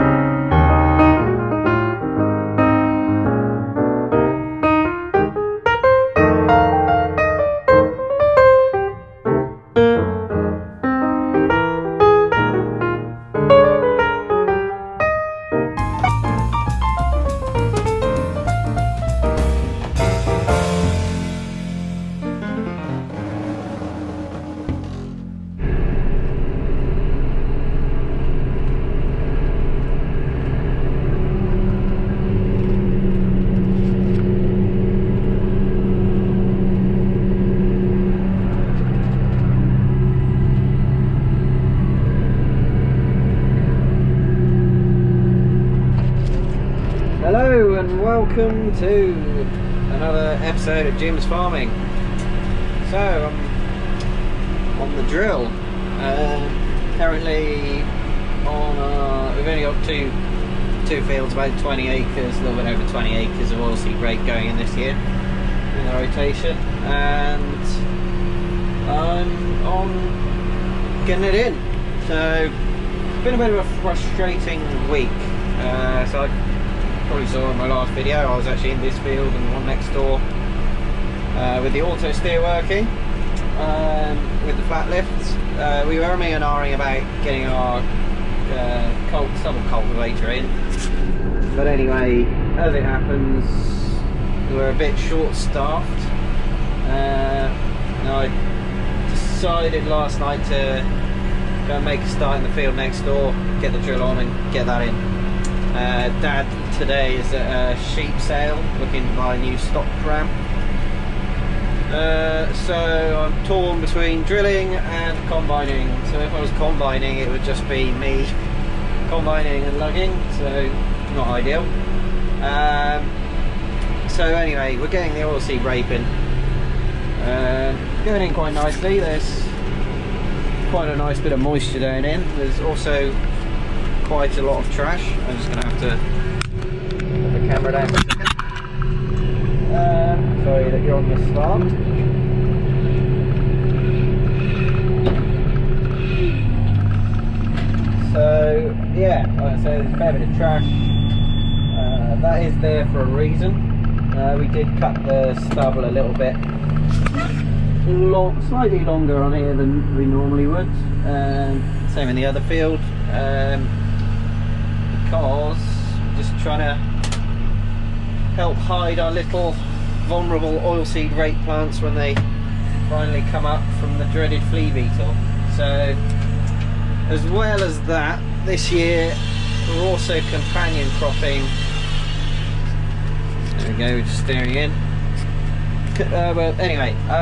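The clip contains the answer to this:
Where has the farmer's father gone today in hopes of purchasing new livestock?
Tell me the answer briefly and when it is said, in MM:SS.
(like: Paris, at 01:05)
A sheep sale, at 01:47.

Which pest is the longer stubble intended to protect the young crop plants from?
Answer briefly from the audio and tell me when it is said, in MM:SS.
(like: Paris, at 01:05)
Flea beetle, at 02:54.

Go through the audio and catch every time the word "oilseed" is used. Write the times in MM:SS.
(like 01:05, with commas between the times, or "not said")
01:03, 02:50.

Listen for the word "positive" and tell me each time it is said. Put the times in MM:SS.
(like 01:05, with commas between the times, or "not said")
not said.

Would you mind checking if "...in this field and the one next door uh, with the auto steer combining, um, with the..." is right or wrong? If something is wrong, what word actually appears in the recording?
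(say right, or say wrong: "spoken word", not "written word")
wrong: "working", not "combining".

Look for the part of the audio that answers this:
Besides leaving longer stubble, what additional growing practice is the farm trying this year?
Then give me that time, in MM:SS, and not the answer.
03:00.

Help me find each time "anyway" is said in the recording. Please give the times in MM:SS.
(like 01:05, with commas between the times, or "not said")
01:31, 02:04, 03:06.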